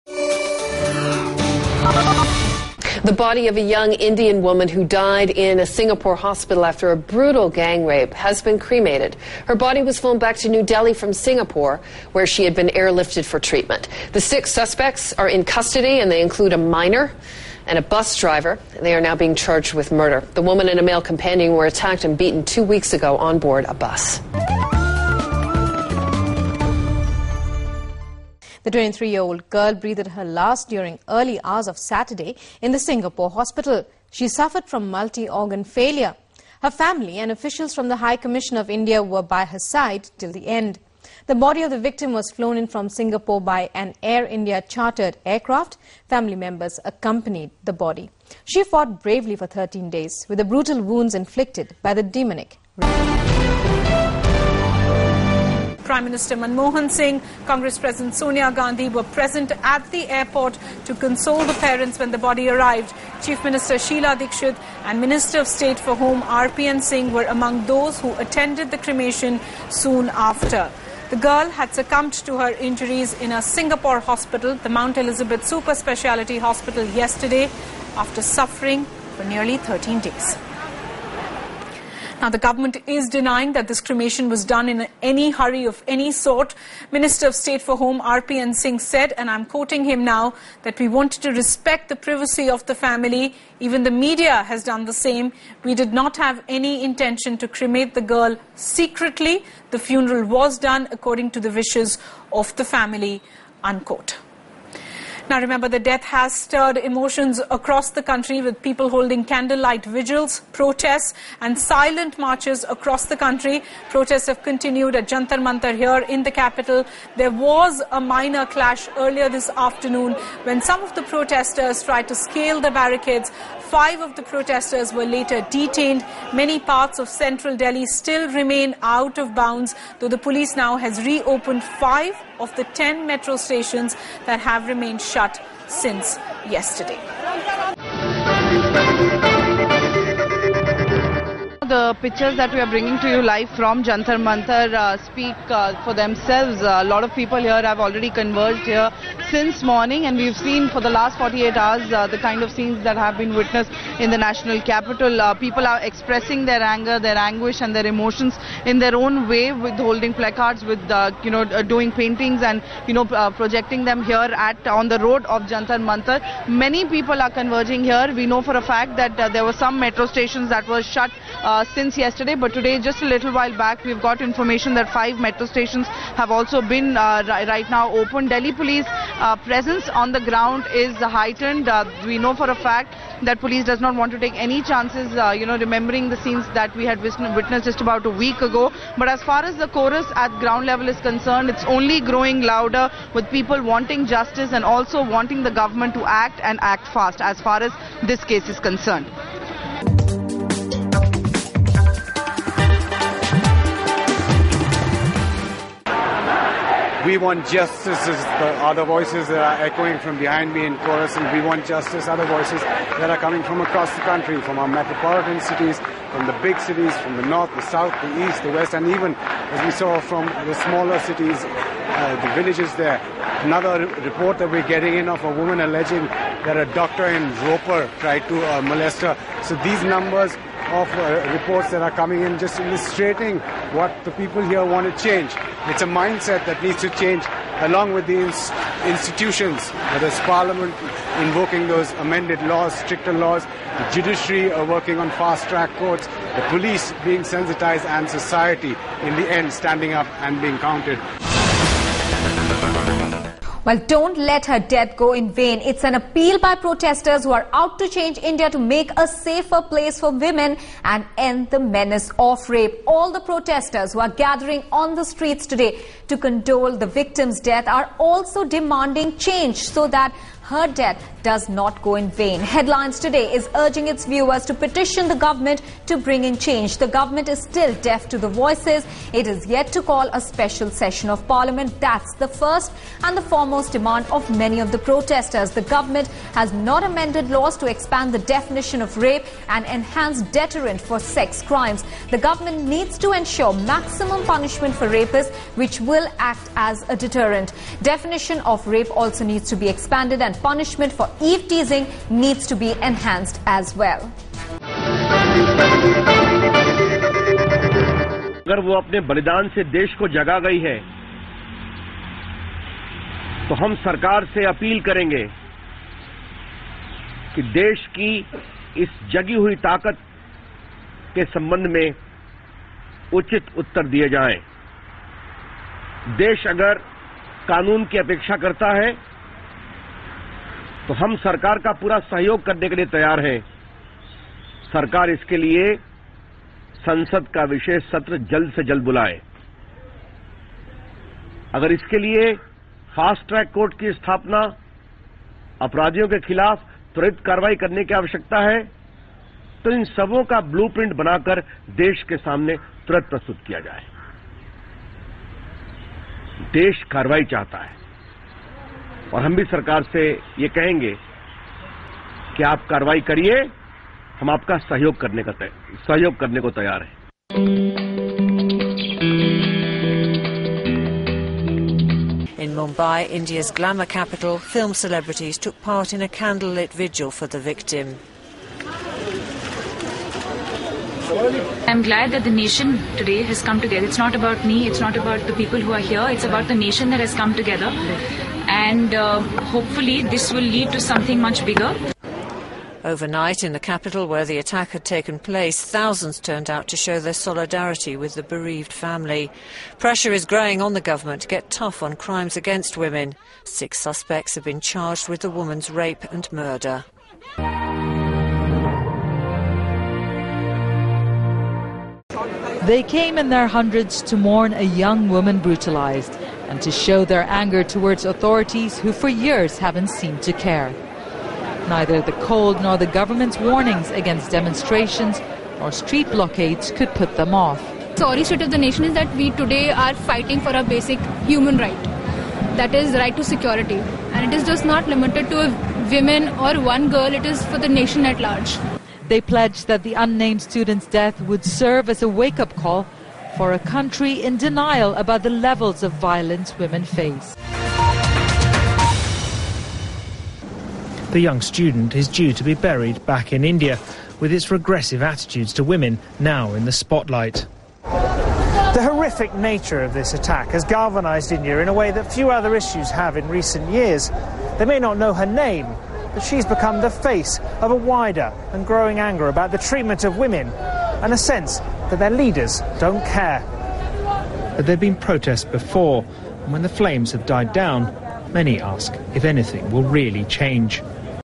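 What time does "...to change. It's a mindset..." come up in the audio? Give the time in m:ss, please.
3:54.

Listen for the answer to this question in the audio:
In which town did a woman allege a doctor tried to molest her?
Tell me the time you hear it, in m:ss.
3:47.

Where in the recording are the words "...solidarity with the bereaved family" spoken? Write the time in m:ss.
6:37.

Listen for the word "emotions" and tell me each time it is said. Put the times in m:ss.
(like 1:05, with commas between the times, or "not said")
1:46, 2:37.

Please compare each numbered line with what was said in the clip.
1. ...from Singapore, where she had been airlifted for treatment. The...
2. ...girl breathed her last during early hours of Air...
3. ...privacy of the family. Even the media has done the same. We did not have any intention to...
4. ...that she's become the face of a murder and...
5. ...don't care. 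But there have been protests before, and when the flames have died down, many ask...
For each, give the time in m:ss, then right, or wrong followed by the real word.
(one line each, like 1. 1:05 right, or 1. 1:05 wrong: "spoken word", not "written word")
1. 0:10 right
2. 0:29 wrong: "Saturday", not "Air"
3. 1:31 right
4. 7:46 wrong: "wider", not "murder"
5. 7:52 right.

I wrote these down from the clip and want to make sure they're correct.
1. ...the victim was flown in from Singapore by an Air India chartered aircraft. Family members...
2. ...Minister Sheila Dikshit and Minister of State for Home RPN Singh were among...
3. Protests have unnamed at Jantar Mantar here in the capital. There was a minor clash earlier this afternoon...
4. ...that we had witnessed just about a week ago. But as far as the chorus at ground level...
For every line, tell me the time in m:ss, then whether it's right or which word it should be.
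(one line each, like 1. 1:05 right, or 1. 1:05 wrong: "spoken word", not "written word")
1. 0:41 right
2. 1:03 right
3. 1:53 wrong: "continued", not "unnamed"
4. 3:06 right.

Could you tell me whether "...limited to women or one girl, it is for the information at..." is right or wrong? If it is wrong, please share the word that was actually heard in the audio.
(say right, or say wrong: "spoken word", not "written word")
wrong: "nation", not "information".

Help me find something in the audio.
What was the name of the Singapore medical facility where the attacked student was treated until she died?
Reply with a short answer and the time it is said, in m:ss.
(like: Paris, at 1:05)
Mount Elizabeth Super Speciality Hospital, at 1:14.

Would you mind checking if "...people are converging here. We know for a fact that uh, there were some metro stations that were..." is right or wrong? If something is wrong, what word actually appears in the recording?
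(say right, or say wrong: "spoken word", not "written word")
right.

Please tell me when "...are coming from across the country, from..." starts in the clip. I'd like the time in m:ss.
3:33.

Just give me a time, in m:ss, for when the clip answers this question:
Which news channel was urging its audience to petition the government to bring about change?
4:32.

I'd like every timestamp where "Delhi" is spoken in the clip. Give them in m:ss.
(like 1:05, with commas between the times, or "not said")
0:10, 2:07, 2:58.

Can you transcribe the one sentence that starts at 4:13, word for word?
Well, don't let her death go in vain.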